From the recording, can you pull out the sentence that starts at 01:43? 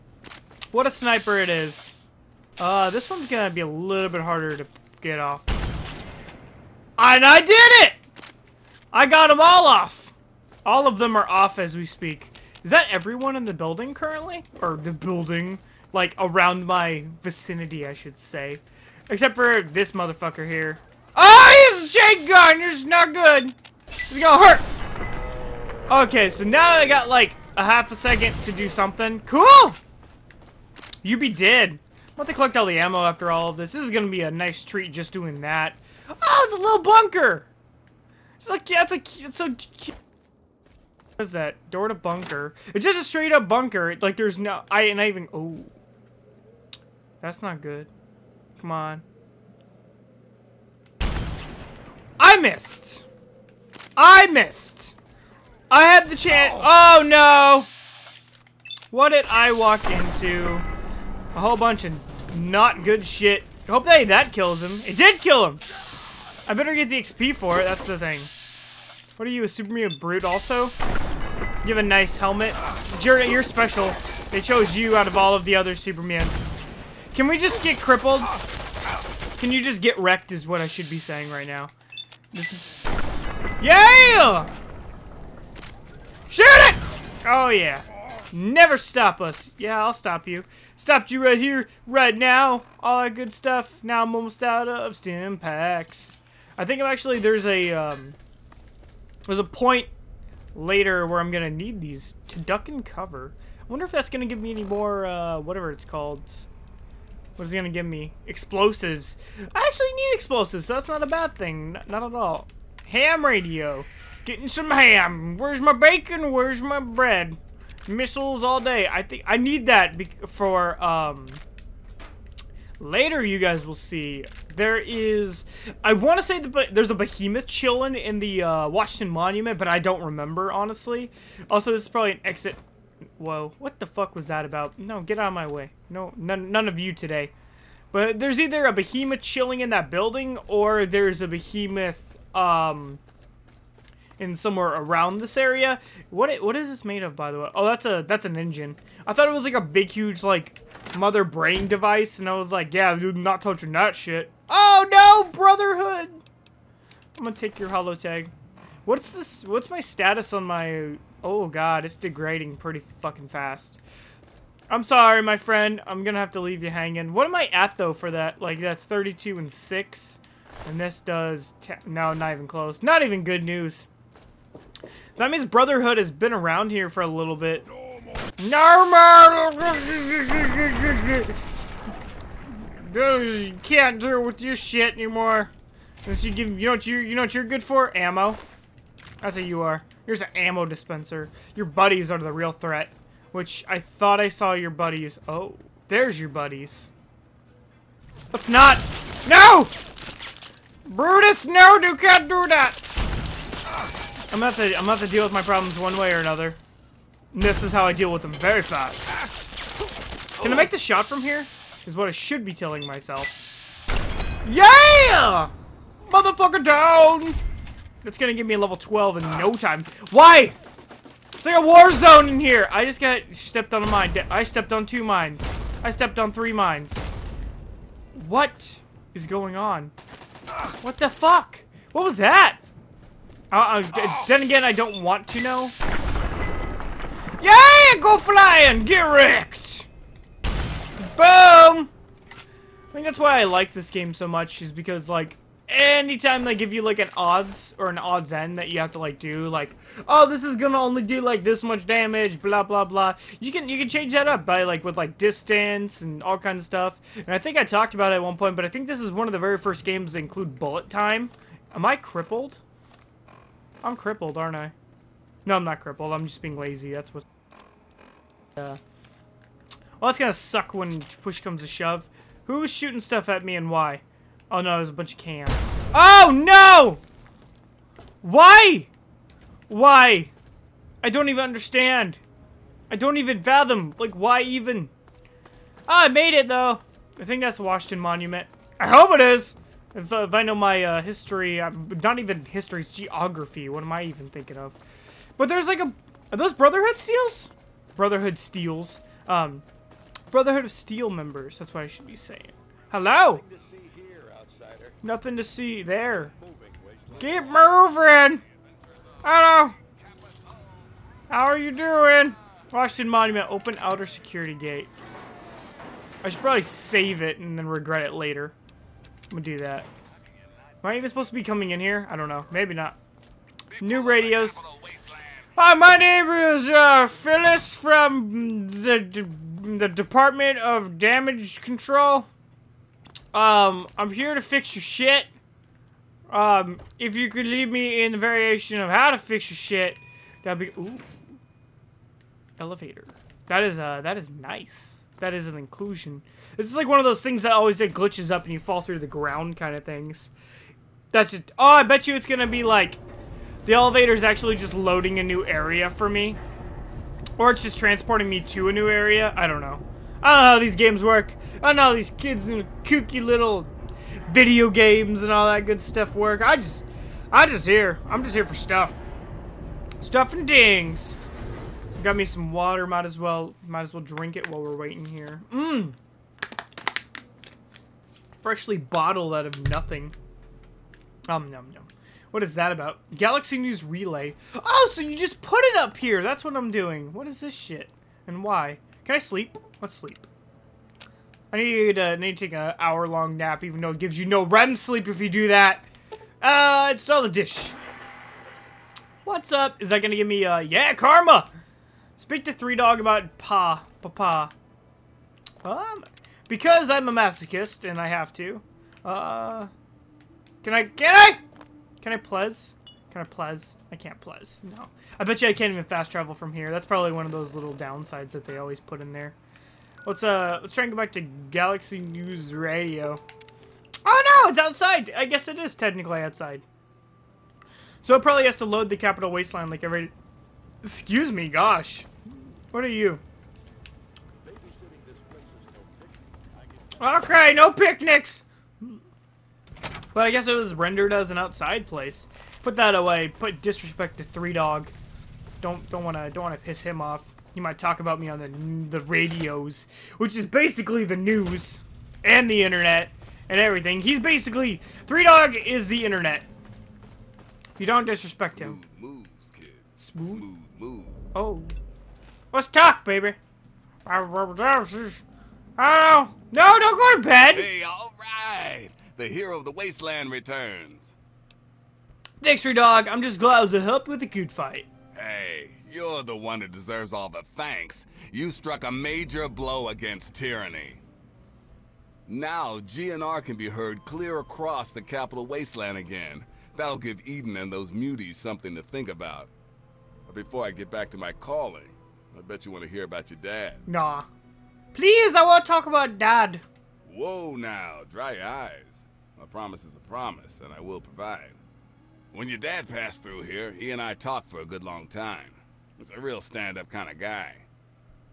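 I wonder if that's going to give me any more, uh, whatever it's called.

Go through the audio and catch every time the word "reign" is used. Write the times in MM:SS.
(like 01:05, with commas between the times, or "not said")
not said.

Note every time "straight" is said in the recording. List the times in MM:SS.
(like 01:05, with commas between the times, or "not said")
00:43.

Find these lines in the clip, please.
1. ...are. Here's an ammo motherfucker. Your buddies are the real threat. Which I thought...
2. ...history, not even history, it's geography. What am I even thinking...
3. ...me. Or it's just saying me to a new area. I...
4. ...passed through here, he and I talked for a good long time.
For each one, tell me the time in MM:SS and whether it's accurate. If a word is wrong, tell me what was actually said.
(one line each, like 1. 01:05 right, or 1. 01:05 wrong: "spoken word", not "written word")
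1. 03:09 wrong: "dispenser", not "motherfucker"
2. 04:51 right
3. 05:56 wrong: "transporting", not "saying"
4. 08:22 right.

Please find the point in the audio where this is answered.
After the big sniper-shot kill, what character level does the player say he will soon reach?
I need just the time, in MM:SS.
03:38.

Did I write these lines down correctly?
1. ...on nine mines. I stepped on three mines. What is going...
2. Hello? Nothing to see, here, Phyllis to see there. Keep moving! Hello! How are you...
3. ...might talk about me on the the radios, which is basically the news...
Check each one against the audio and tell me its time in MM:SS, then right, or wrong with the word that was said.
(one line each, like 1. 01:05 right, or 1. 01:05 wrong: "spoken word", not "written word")
1. 03:44 wrong: "two", not "nine"
2. 05:02 wrong: "Nothing", not "Phyllis"
3. 07:27 right.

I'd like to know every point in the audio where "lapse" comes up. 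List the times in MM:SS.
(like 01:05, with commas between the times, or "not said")
not said.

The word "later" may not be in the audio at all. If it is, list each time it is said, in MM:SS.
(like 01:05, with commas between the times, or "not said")
01:40, 02:02, 05:18.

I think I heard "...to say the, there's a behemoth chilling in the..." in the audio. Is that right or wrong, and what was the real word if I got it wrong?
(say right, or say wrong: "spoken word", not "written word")
right.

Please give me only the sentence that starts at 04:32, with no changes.
Who was shooting stuff at me and why?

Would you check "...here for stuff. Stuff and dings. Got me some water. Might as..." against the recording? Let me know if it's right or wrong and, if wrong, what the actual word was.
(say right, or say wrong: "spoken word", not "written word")
right.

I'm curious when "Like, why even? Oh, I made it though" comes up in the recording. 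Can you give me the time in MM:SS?
04:43.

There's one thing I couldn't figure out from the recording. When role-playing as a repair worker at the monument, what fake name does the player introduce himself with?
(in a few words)
Phyllis.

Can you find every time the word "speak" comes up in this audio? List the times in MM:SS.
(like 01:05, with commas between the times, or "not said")
00:11, 06:42.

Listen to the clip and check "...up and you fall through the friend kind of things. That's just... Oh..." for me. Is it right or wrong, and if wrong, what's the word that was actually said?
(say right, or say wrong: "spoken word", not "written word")
wrong: "ground", not "friend".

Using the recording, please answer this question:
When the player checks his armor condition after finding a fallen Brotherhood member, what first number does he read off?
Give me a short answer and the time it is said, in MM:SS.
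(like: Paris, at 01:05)
32, at 02:48.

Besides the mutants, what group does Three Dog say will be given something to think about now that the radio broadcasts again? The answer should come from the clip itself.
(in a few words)
Eden.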